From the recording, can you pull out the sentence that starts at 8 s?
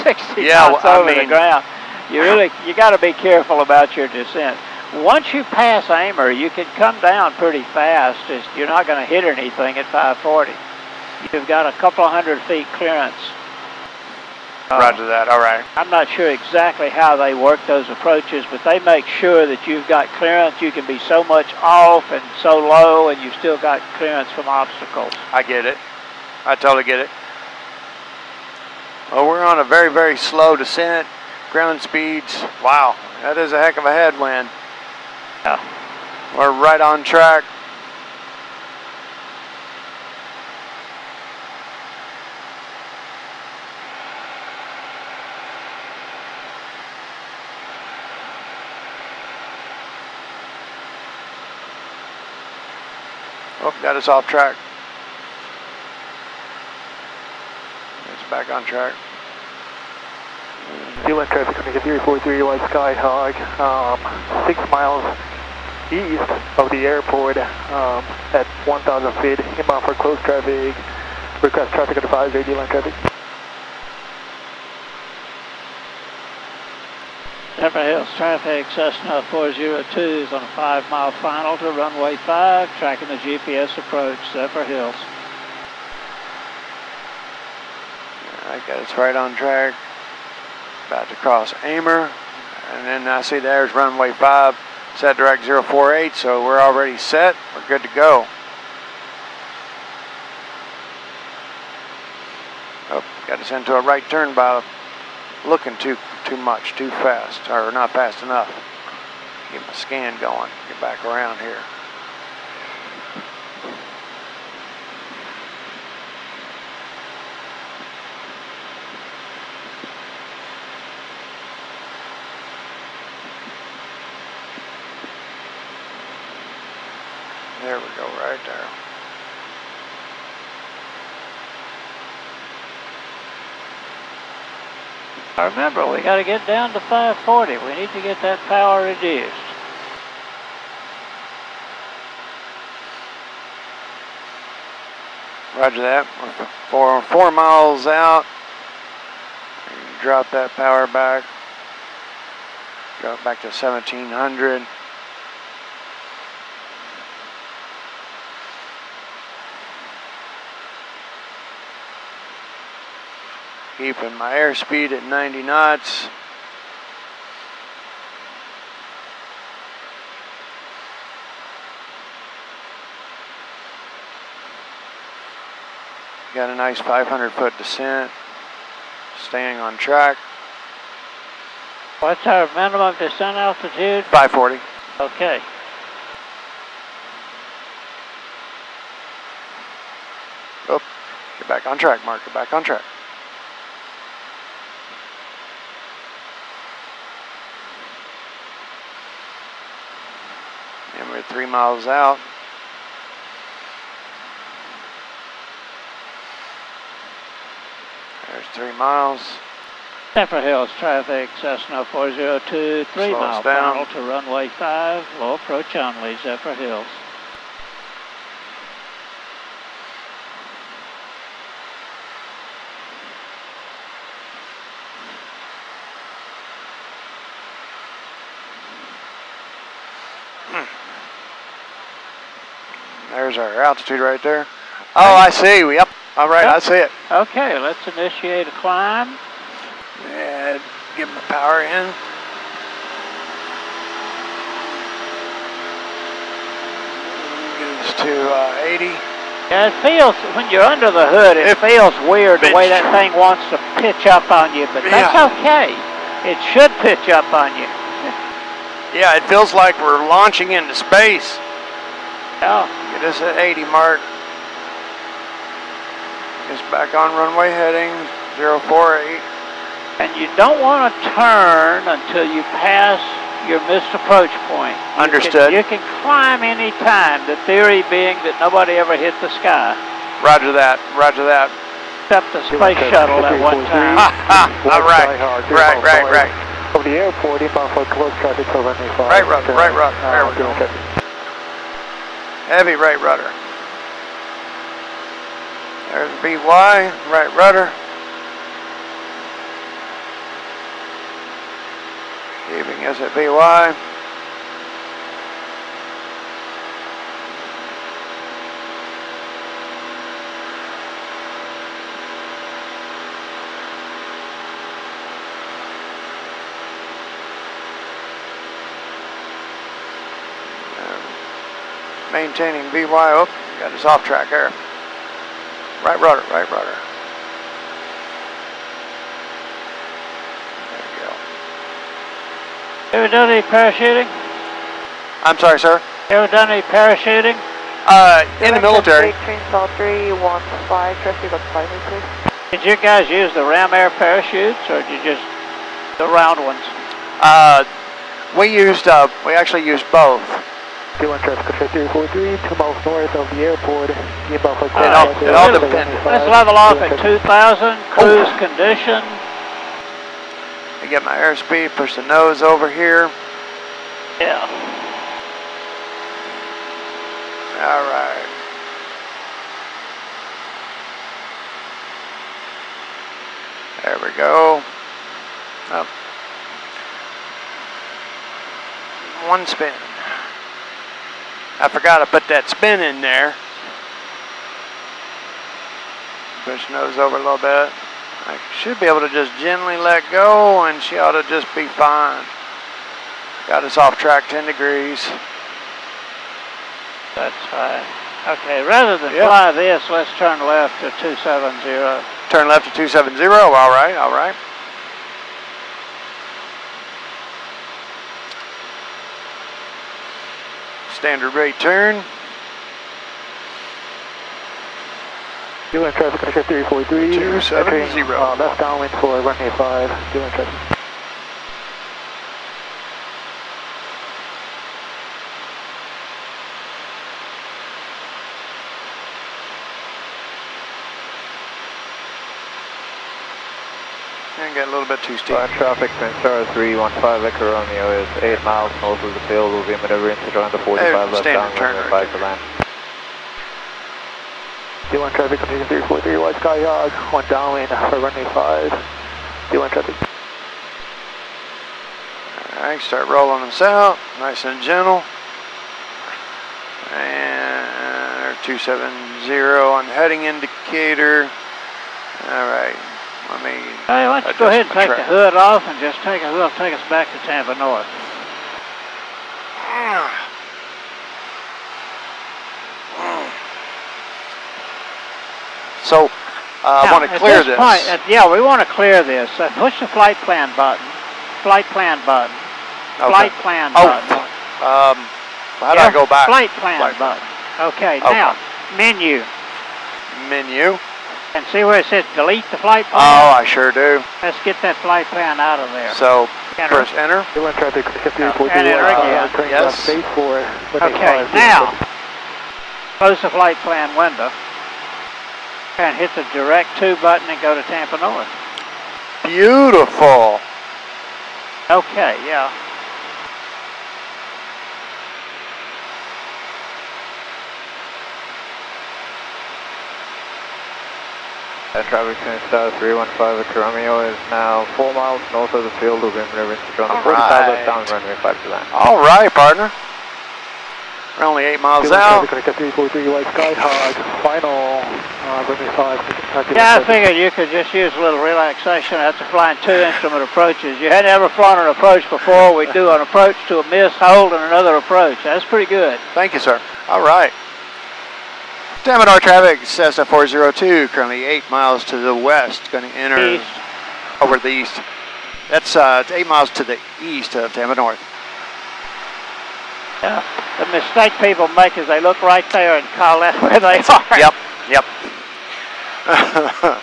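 It's, you're not going to hit anything at 540.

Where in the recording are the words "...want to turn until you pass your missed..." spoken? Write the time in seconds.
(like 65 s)
270 s.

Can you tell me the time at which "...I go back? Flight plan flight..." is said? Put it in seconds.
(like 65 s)
485 s.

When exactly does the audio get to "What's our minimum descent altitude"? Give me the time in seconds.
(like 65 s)
181 s.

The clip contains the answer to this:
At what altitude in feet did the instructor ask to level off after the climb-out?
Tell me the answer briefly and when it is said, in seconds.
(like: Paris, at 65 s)
2,000, at 357 s.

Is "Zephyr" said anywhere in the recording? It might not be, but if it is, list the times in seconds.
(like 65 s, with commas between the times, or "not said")
77 s, 84 s, 210 s, 216 s.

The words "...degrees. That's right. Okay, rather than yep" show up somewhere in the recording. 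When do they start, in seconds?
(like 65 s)
394 s.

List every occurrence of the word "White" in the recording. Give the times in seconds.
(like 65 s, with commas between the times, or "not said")
62 s, 446 s, 533 s.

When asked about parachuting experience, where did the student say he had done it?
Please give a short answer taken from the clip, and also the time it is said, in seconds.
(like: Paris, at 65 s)
In the military, at 338 s.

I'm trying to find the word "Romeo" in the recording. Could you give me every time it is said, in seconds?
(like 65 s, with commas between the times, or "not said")
437 s, 523 s.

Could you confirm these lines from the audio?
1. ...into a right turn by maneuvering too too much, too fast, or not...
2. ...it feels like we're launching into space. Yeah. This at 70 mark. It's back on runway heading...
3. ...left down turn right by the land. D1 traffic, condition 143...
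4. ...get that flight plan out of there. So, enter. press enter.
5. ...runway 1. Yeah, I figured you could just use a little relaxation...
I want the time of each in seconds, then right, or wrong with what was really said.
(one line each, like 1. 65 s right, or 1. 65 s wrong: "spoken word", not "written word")
1. 103 s wrong: "looking", not "maneuvering"
2. 259 s wrong: "80", not "70"
3. 441 s wrong: "343", not "143"
4. 494 s right
5. 535 s wrong: "5", not "1".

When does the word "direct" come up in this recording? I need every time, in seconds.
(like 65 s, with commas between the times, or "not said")
95 s, 506 s.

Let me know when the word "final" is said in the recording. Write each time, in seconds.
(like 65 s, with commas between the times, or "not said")
81 s, 213 s, 534 s.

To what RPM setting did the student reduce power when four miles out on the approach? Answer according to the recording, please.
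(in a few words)
1700.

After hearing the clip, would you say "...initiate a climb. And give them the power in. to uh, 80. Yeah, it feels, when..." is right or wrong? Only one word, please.
right.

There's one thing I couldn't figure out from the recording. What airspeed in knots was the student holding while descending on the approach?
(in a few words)
90.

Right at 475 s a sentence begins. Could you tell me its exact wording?
So, uh, now, I want to clear this.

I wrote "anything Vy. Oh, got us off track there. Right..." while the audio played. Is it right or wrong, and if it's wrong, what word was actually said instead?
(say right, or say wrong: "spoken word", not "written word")
wrong: "maintaining", not "anything".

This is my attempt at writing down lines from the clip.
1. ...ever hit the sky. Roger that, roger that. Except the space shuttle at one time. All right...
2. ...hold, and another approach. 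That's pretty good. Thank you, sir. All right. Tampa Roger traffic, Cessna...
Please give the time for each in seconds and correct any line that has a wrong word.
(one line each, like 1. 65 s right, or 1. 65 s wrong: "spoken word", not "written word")
1. 278 s right
2. 543 s wrong: "North", not "Roger".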